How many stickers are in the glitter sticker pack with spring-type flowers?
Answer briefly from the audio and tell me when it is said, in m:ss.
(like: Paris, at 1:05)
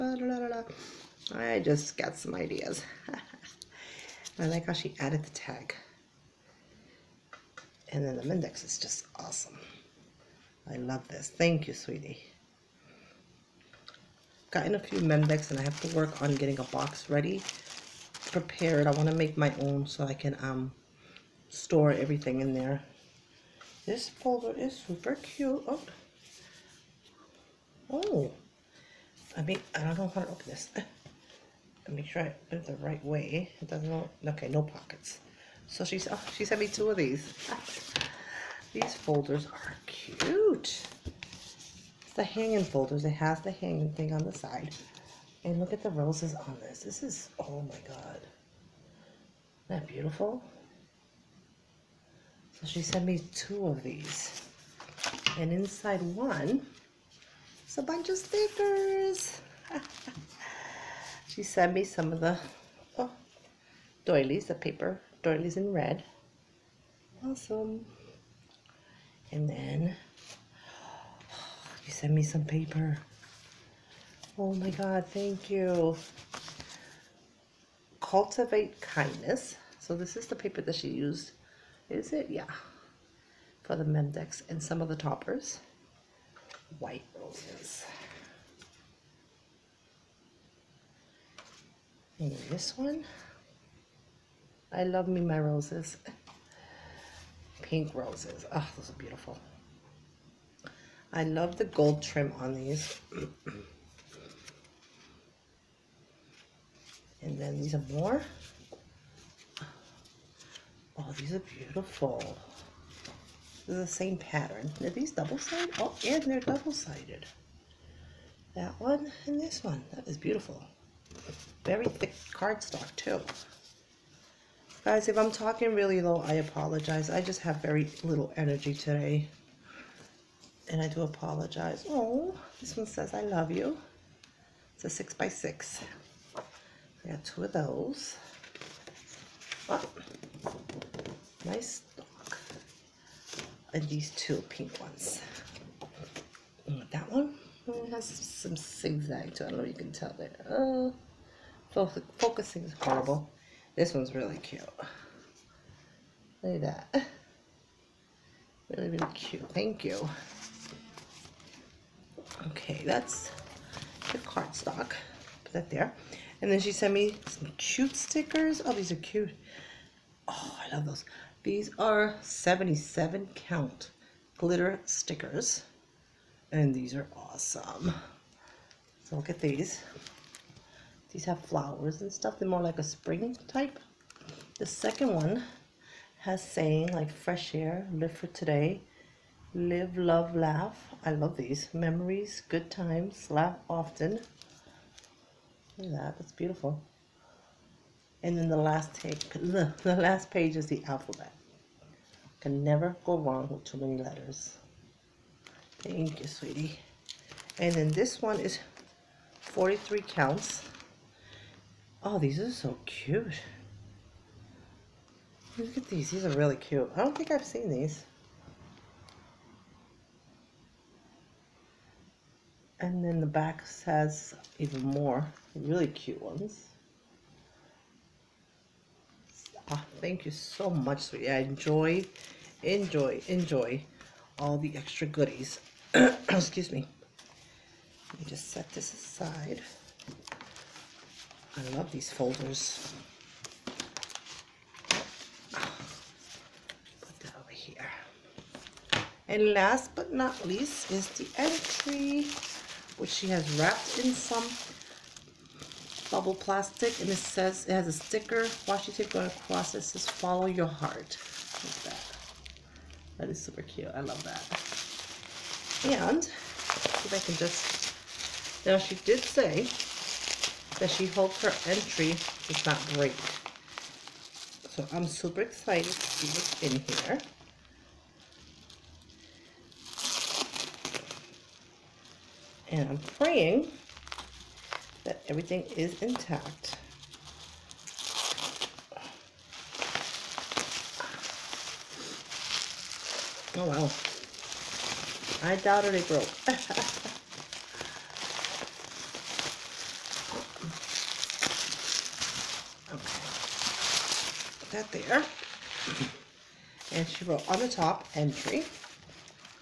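77, at 2:52.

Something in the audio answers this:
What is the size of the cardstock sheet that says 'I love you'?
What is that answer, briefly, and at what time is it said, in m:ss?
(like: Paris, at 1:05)
6 by 6, at 2:14.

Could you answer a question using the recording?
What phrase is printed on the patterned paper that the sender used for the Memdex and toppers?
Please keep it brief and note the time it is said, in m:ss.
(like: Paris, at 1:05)
Cultivate Kindness, at 1:18.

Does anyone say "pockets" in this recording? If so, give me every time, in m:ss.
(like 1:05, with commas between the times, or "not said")
0:34.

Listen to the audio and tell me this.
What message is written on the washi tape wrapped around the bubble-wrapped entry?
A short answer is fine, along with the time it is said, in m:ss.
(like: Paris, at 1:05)
follow your heart, at 4:20.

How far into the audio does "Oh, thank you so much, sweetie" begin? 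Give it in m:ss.
3:49.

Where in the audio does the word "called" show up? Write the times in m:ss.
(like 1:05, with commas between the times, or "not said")
not said.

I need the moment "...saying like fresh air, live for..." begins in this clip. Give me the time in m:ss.
3:06.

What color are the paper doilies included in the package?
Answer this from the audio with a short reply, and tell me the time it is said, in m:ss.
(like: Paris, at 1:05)
red, at 1:05.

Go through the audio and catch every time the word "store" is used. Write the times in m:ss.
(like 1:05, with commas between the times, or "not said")
0:21.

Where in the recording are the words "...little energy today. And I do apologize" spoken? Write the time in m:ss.
2:08.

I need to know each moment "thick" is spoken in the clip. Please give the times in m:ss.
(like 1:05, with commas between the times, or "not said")
2:01.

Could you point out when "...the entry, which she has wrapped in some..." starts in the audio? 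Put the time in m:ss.
4:11.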